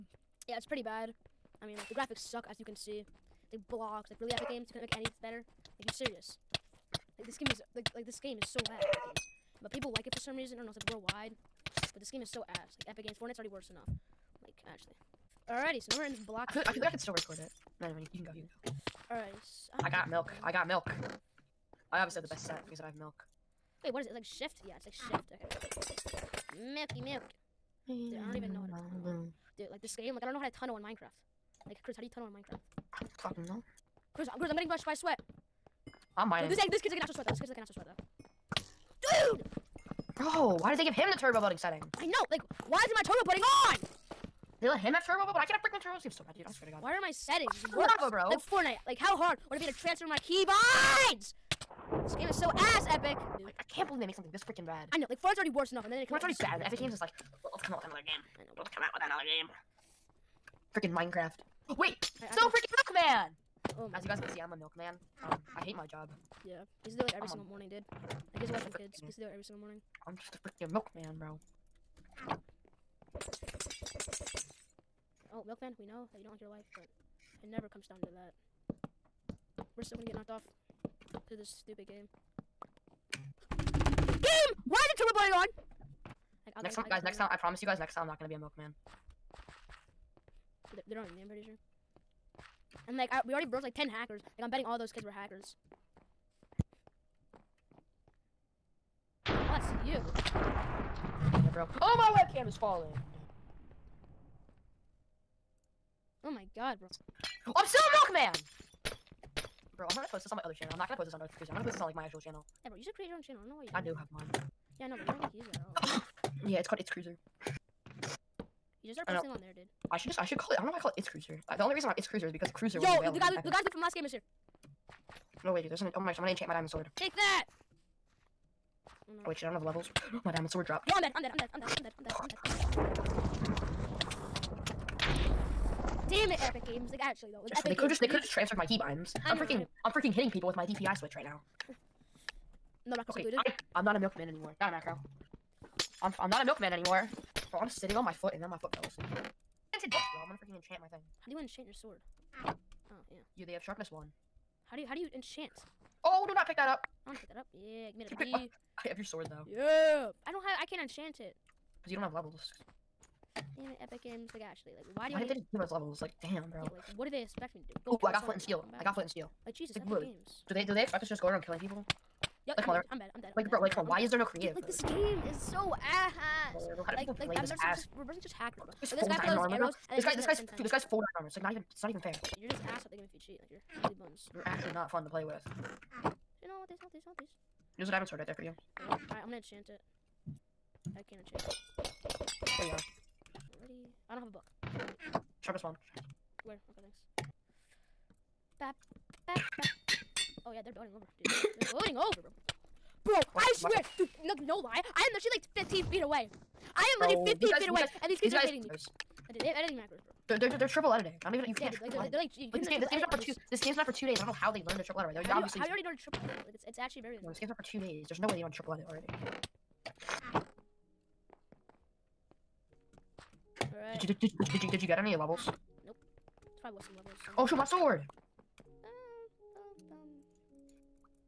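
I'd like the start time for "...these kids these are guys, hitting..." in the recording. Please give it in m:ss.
3:28.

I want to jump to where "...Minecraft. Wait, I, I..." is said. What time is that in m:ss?
1:00.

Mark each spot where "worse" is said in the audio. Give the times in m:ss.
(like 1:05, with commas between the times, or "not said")
0:13, 0:47, 0:55.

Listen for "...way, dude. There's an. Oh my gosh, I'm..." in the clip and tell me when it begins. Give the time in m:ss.
2:05.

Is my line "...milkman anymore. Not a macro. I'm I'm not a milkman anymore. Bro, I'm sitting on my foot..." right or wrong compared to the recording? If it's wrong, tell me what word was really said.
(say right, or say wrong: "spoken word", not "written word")
right.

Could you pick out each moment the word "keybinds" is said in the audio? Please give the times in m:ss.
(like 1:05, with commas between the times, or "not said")
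0:50, 2:18.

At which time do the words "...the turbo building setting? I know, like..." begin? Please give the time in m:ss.
0:41.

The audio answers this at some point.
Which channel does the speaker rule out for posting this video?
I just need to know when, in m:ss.
1:51.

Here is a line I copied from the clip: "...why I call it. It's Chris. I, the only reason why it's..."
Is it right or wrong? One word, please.
wrong.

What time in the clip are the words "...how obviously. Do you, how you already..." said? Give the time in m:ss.
3:35.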